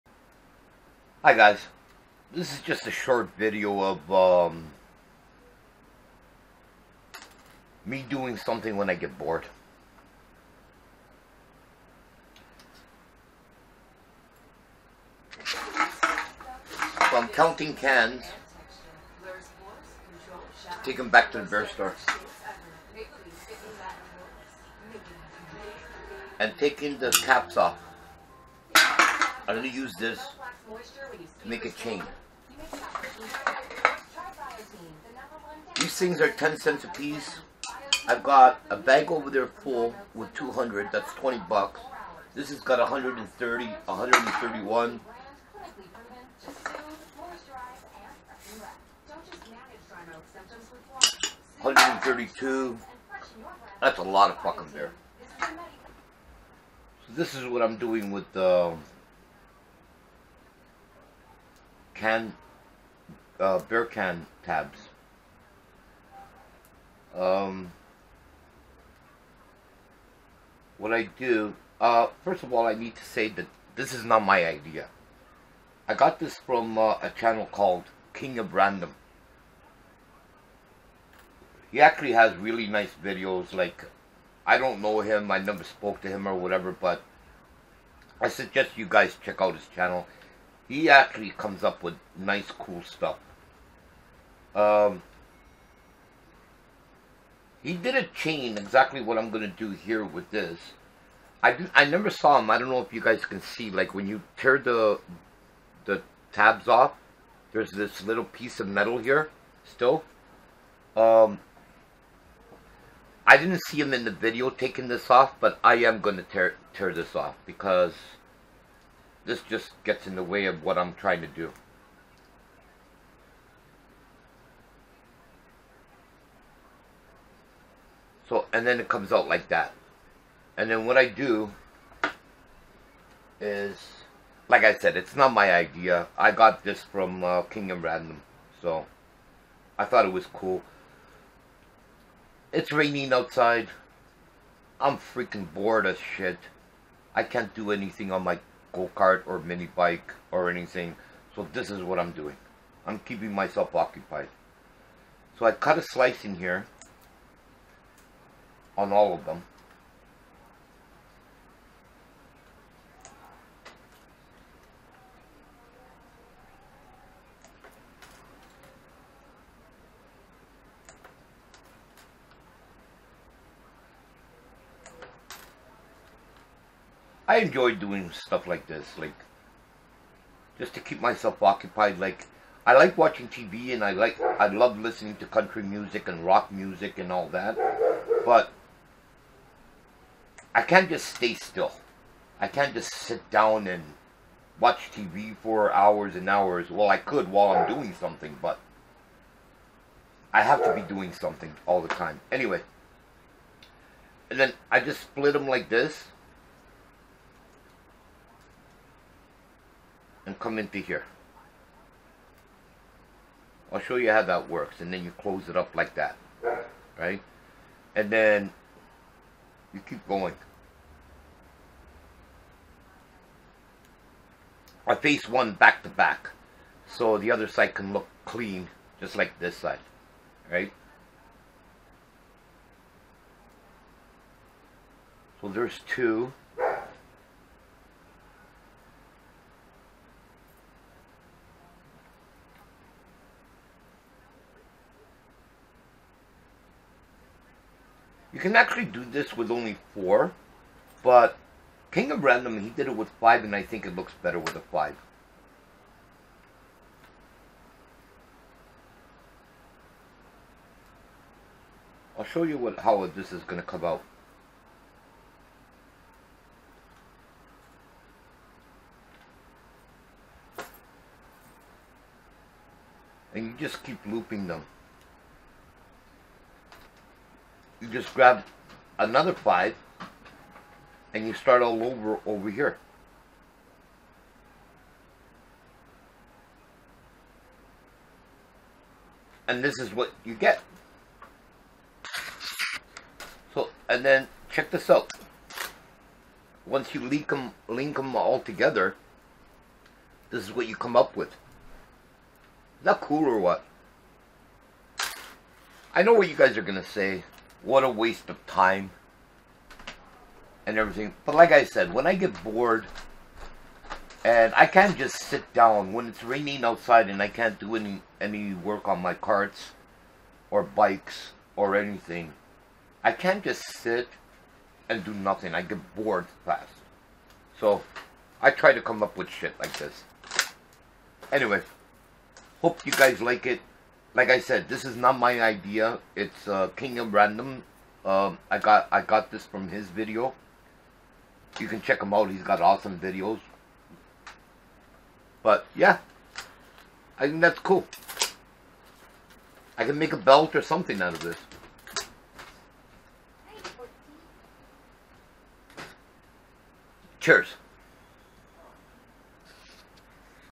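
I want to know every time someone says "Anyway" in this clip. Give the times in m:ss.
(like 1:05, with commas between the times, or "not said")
3:22, 5:31.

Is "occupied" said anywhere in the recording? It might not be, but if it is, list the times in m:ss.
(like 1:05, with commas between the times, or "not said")
2:33, 3:01.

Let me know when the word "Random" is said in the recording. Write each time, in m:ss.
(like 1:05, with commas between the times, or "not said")
1:18, 2:17, 4:12, 5:37.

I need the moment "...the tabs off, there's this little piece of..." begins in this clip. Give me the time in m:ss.
1:45.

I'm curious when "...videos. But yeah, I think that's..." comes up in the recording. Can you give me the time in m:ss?
5:42.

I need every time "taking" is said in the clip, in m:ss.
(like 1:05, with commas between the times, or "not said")
0:26, 1:54.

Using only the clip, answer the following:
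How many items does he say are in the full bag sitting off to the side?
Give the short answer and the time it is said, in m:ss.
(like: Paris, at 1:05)
200, at 0:40.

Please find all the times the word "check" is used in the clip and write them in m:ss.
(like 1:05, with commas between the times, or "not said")
1:29, 4:54, 5:41.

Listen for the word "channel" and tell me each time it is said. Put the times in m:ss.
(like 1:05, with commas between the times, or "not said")
1:17, 1:29.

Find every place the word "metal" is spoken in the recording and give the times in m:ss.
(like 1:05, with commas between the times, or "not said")
1:48.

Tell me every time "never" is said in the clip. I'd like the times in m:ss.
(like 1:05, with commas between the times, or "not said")
1:25, 1:41.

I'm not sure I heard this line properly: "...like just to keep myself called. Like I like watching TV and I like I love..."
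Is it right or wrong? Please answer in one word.
wrong.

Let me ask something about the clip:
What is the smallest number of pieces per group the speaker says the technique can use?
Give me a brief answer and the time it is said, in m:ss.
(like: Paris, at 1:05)
4, at 4:09.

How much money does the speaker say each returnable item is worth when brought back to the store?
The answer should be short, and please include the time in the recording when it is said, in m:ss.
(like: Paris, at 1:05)
10 cents, at 0:36.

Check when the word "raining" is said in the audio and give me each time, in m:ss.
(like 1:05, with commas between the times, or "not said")
2:22, 5:16.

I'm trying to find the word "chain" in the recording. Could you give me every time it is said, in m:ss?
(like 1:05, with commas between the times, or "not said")
0:31, 1:38.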